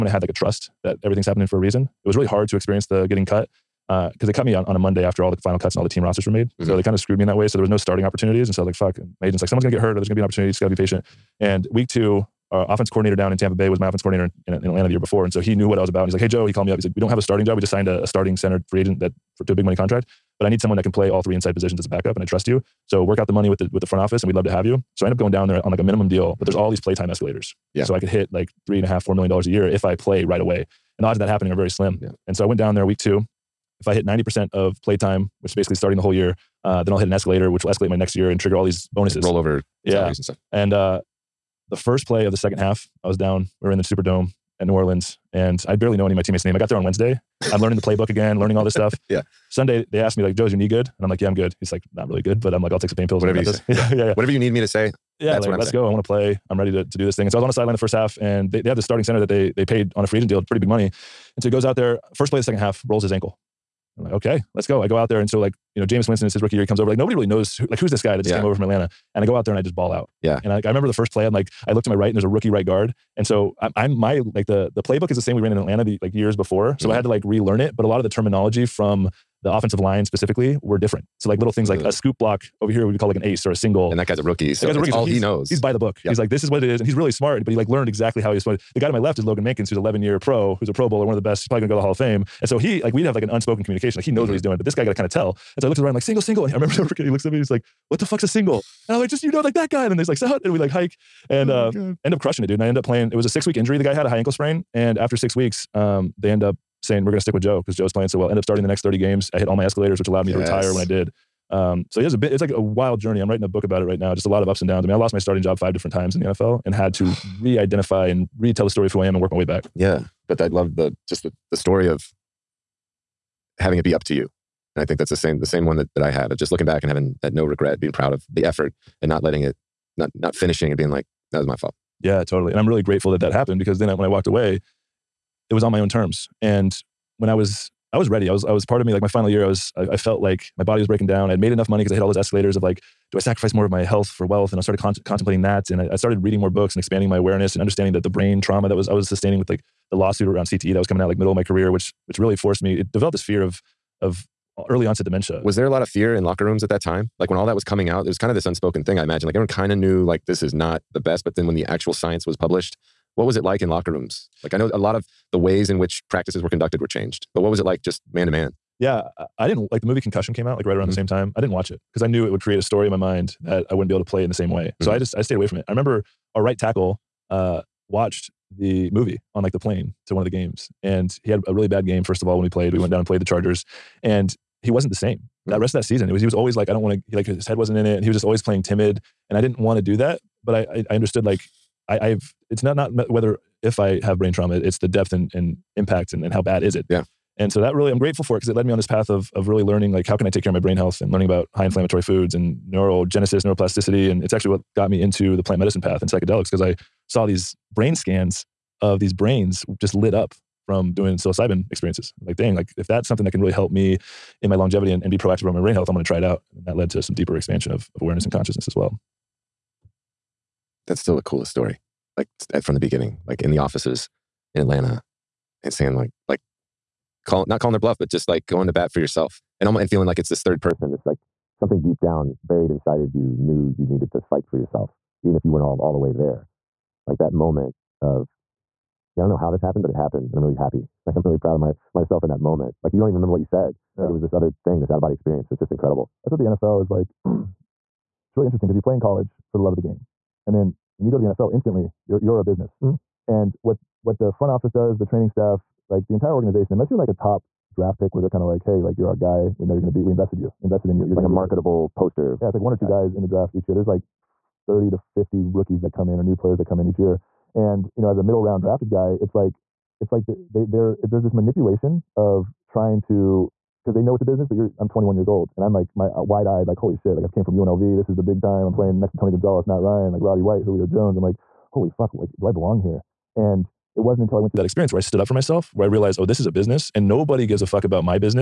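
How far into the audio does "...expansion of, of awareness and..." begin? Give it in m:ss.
3:37.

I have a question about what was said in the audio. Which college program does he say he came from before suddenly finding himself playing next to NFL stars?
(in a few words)
UNLV.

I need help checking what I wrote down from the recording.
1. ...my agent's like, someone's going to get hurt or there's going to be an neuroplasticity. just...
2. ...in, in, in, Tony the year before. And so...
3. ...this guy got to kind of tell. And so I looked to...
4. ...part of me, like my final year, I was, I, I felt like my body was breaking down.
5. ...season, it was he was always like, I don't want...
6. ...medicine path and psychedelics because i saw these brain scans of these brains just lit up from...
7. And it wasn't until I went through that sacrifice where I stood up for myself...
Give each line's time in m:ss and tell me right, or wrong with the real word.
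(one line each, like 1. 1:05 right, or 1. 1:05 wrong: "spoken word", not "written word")
1. 0:09 wrong: "opportunity", not "neuroplasticity"
2. 0:14 wrong: "Atlanta", not "Tony"
3. 1:34 right
4. 2:18 right
5. 3:05 right
6. 3:25 right
7. 4:43 wrong: "experience", not "sacrifice".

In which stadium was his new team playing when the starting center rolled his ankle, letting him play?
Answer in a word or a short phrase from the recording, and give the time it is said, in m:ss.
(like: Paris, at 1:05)
Superdome, at 0:43.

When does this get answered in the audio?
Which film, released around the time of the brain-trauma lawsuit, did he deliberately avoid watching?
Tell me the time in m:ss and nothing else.
2:49.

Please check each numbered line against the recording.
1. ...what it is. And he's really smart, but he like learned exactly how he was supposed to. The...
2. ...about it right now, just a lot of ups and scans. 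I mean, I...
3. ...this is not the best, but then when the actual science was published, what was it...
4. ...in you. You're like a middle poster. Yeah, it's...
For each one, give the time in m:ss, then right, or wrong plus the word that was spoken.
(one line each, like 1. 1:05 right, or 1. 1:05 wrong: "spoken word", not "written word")
1. 1:26 right
2. 1:53 wrong: "downs", not "scans"
3. 2:40 right
4. 4:20 wrong: "marketable", not "middle".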